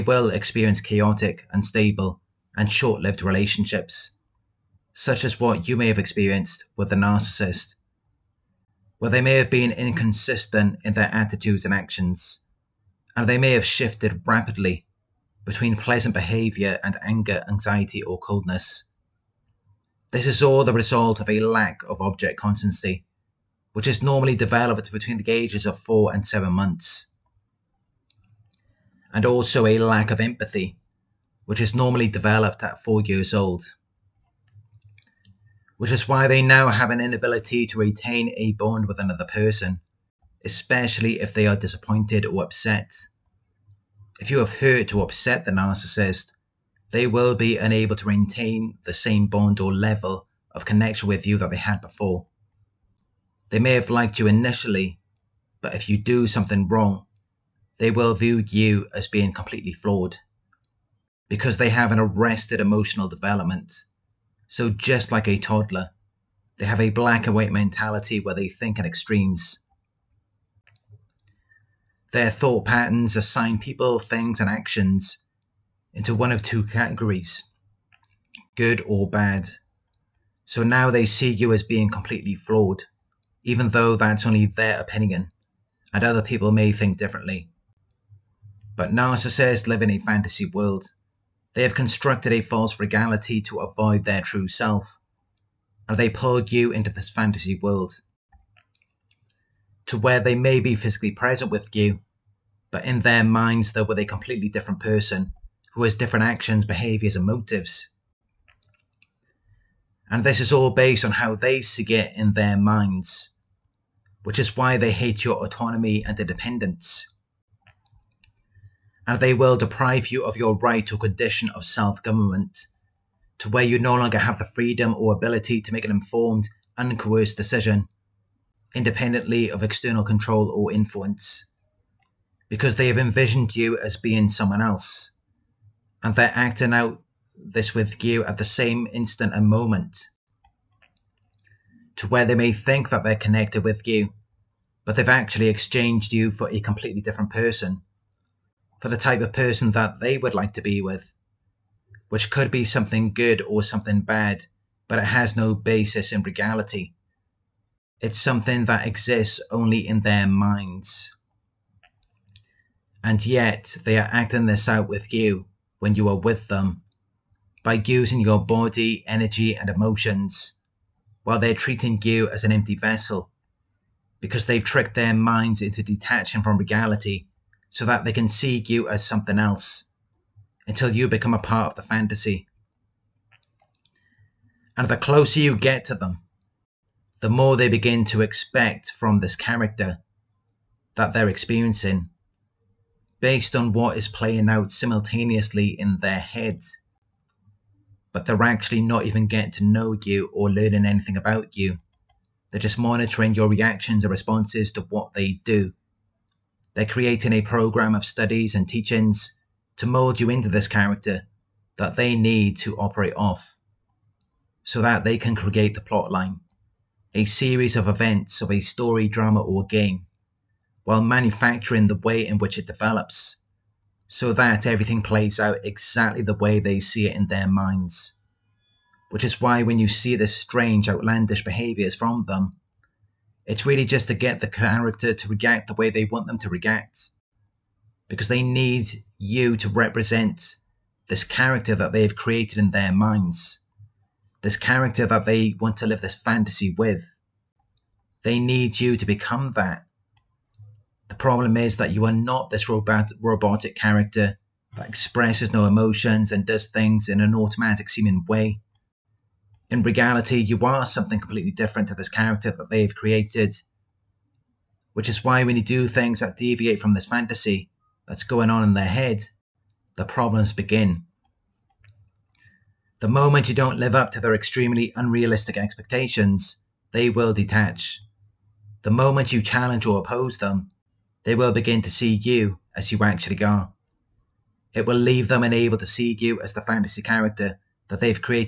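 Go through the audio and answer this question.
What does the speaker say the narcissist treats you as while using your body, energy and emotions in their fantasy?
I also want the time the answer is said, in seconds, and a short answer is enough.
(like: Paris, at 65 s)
An empty vessel, at 172 s.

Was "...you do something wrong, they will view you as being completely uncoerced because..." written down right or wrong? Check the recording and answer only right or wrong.
wrong.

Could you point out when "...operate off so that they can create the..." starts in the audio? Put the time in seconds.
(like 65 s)
212 s.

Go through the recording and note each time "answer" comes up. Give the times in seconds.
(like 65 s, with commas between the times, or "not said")
not said.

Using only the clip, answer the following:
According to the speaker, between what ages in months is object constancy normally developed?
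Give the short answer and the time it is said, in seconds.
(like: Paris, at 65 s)
4 and 7 months, at 25 s.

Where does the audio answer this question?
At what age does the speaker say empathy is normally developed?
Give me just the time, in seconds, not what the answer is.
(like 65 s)
32 s.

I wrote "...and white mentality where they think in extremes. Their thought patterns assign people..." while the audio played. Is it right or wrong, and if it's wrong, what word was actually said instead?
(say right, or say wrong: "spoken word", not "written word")
right.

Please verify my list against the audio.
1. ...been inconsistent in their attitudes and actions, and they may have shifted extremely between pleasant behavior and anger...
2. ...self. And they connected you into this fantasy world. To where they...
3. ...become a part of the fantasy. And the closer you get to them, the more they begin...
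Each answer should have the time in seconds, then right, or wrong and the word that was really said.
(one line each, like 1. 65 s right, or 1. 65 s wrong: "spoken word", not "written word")
1. 9 s wrong: "rapidly", not "extremely"
2. 94 s wrong: "pulled", not "connected"
3. 181 s right.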